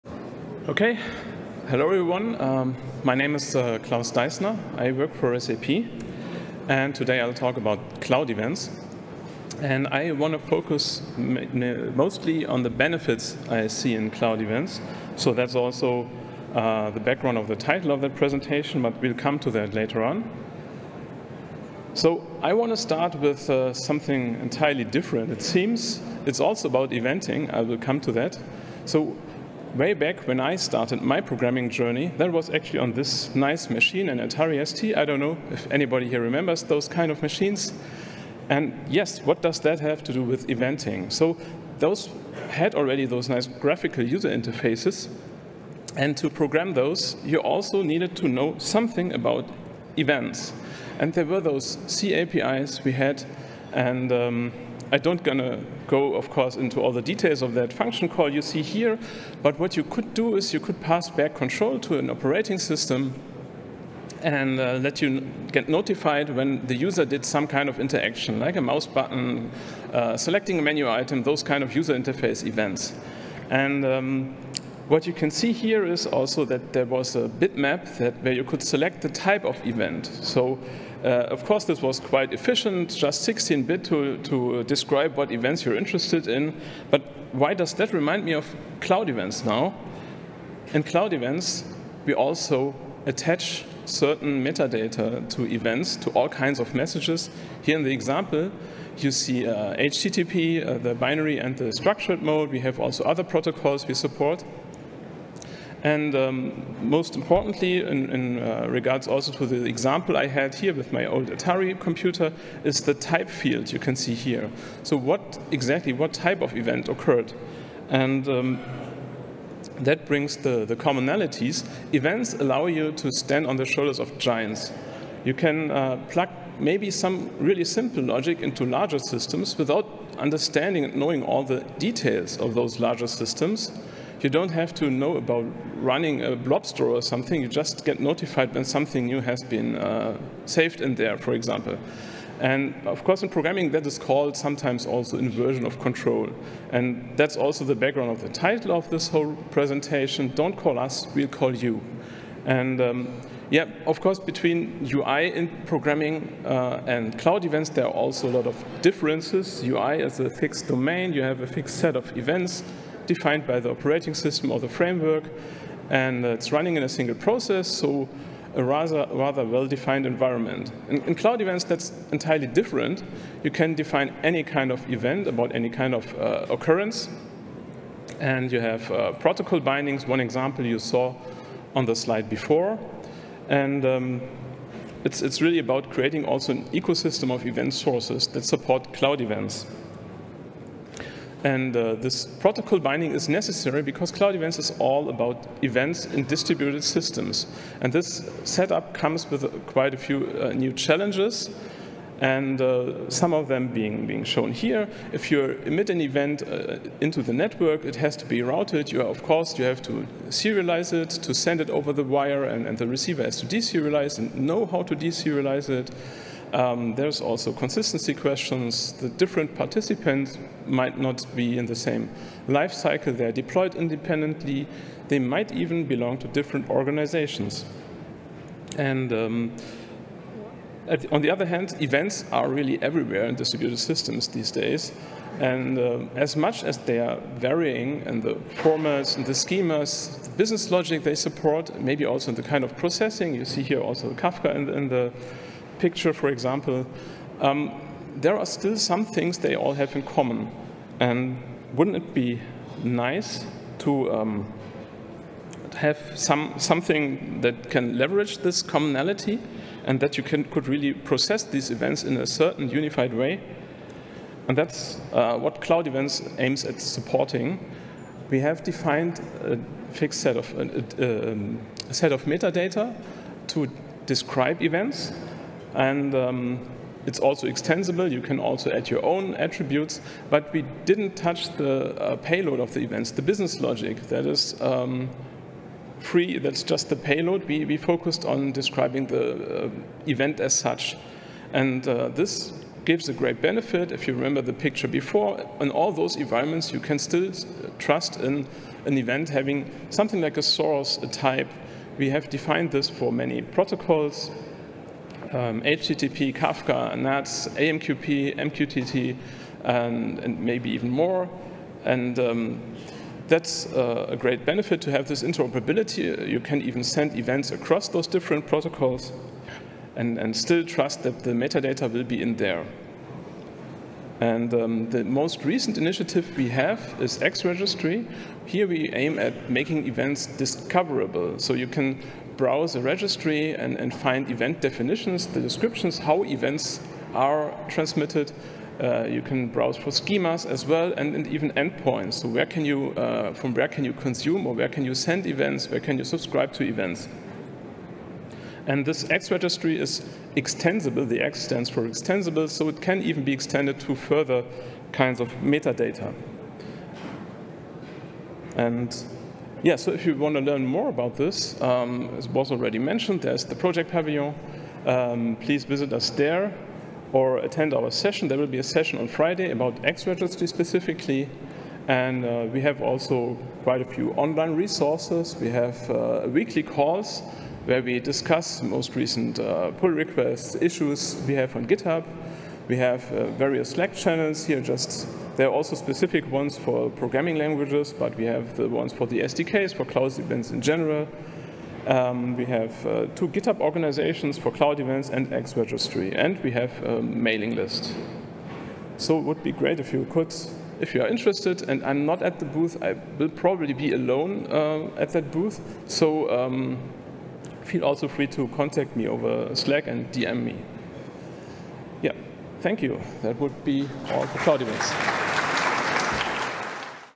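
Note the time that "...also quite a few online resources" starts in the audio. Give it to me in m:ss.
6:12.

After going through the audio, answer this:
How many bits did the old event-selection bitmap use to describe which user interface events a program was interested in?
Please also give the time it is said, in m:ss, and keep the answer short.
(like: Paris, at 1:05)
16, at 1:23.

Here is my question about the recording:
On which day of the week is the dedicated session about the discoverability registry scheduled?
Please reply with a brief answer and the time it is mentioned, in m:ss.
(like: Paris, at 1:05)
Friday, at 6:09.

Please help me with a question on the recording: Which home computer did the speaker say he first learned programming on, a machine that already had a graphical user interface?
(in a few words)
Atari ST.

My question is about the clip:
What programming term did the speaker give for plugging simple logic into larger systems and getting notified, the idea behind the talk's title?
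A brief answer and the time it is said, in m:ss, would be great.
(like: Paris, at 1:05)
inversion of control, at 2:25.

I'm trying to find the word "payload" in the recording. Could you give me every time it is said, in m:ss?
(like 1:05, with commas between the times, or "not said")
4:42, 4:46.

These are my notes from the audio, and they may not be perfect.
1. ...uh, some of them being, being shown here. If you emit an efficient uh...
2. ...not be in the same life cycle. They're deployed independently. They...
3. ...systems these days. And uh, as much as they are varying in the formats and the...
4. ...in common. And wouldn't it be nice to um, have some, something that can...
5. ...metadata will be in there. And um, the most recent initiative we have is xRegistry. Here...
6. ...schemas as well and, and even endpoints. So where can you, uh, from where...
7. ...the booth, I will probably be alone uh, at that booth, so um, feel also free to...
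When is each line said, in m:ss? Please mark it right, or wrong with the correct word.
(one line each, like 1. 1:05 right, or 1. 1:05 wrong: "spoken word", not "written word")
1. 3:22 wrong: "event", not "efficient"
2. 3:40 right
3. 3:53 right
4. 4:09 right
5. 5:21 right
6. 5:39 right
7. 6:42 right.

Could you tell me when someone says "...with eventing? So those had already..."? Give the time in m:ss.
0:40.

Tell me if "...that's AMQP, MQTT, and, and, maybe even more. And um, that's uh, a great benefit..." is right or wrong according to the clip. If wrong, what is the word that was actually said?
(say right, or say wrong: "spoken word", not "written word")
right.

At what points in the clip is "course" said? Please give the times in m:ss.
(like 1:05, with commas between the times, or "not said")
0:56, 1:21, 2:23, 2:34, 3:29.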